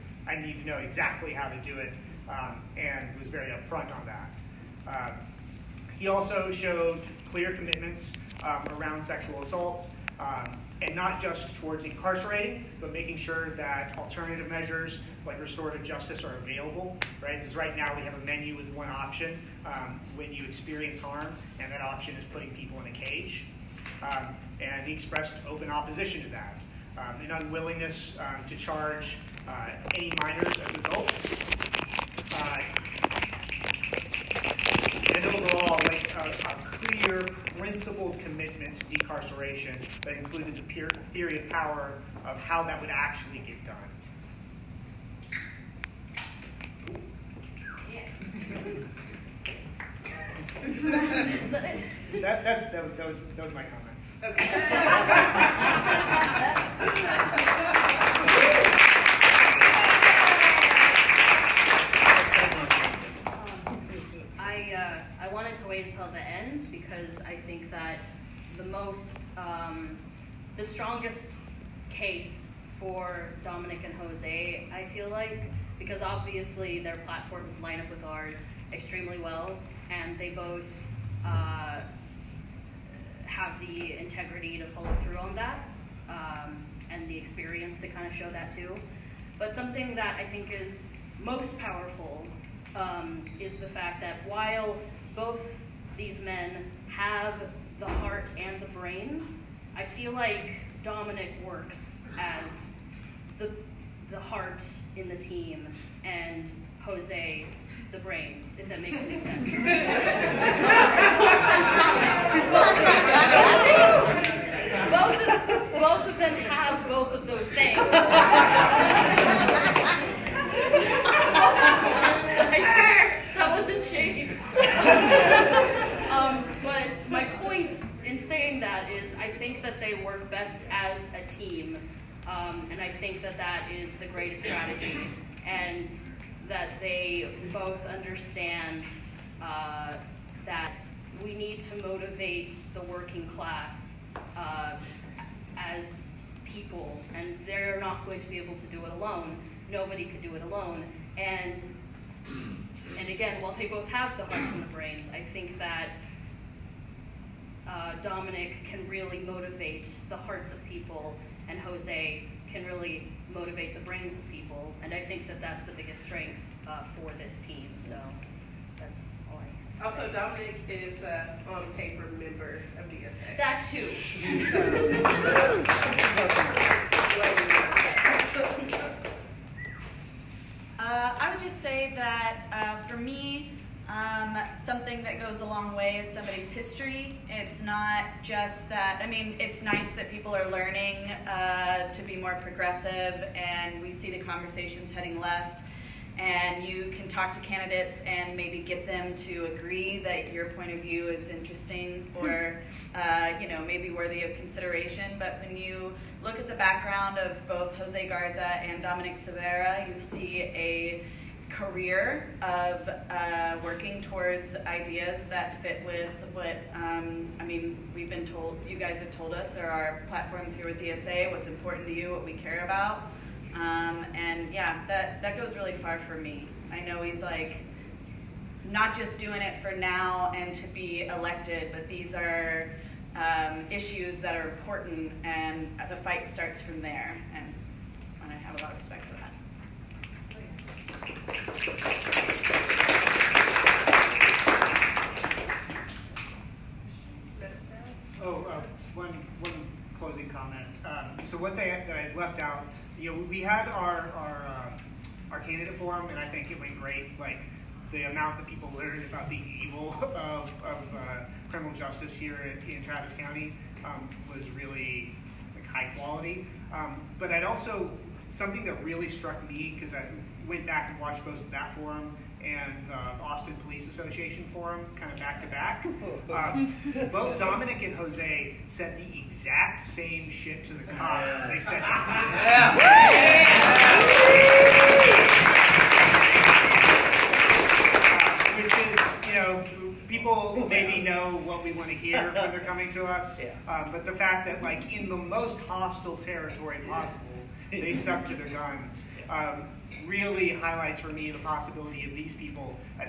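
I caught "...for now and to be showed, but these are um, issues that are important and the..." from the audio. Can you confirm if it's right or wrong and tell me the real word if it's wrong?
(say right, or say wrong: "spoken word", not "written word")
wrong: "elected", not "showed".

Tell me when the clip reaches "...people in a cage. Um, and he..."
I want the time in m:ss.
0:22.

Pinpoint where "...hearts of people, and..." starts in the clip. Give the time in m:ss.
2:40.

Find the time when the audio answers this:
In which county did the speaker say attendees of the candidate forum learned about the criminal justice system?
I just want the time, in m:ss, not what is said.
4:22.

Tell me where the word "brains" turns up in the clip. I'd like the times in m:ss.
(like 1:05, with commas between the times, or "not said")
1:38, 1:47, 2:34, 2:43.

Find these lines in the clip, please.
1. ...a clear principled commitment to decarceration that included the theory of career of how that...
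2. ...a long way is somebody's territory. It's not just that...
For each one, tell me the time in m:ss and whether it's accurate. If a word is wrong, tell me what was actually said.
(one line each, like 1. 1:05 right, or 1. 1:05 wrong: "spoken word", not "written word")
1. 0:36 wrong: "power", not "career"
2. 3:05 wrong: "history", not "territory".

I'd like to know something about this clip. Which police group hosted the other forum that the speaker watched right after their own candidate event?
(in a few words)
Austin Police Association.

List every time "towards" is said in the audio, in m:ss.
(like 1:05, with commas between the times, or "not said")
0:11, 3:34.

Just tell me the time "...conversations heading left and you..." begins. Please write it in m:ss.
3:14.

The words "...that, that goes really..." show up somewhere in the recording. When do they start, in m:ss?
3:44.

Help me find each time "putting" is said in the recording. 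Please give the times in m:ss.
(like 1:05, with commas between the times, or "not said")
0:22.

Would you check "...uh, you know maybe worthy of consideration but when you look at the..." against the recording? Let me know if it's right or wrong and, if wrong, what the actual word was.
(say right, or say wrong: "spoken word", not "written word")
right.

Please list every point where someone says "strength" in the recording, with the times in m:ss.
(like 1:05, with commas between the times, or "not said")
2:46.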